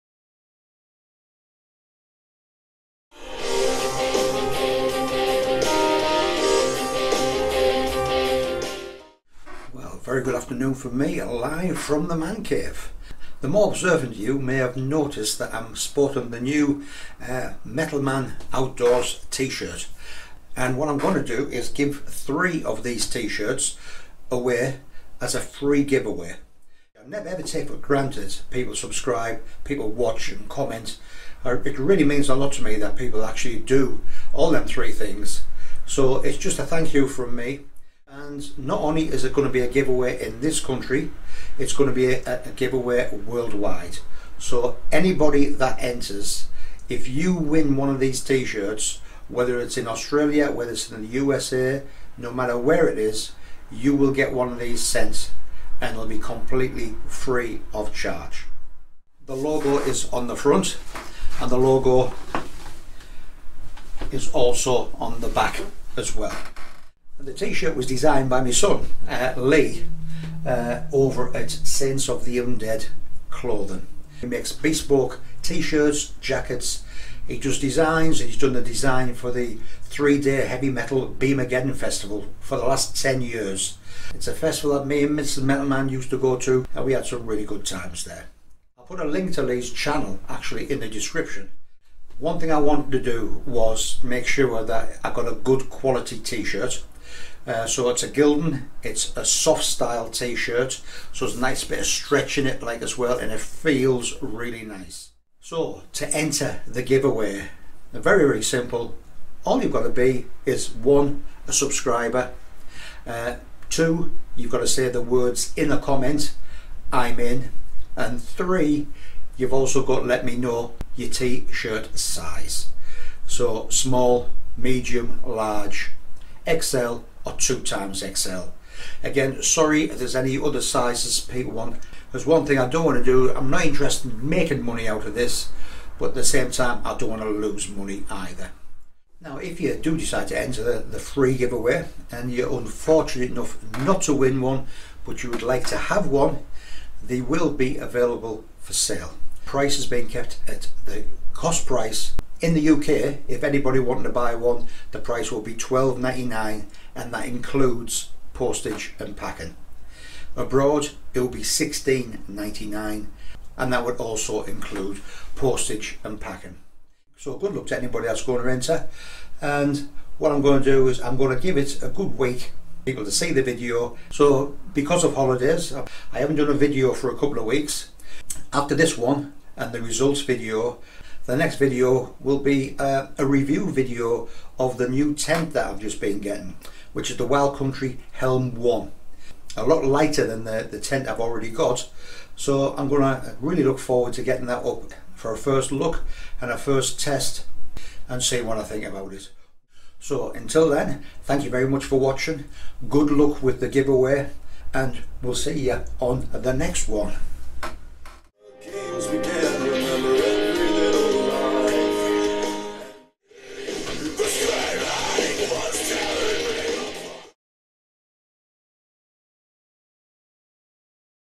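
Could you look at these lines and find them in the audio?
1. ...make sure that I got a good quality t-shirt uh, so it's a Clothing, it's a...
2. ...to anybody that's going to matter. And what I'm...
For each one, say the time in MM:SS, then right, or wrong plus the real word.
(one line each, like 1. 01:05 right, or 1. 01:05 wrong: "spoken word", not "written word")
1. 01:34 wrong: "Gildan", not "Clothing"
2. 02:47 wrong: "enter", not "matter".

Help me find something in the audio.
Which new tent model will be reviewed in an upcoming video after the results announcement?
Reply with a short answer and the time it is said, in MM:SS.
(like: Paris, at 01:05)
Wild Country Helm 1, at 03:07.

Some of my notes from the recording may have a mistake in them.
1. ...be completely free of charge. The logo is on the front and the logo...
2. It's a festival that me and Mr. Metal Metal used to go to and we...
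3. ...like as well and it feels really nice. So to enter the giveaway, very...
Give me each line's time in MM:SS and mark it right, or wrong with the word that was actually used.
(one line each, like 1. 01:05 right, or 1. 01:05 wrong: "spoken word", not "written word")
1. 00:56 right
2. 01:24 wrong: "Man", not "Metal"
3. 01:42 right.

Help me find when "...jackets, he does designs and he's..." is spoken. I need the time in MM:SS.
01:16.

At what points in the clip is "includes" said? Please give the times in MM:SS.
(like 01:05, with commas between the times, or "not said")
02:37, 02:44.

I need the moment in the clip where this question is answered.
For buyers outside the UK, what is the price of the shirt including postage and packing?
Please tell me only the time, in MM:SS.
02:41.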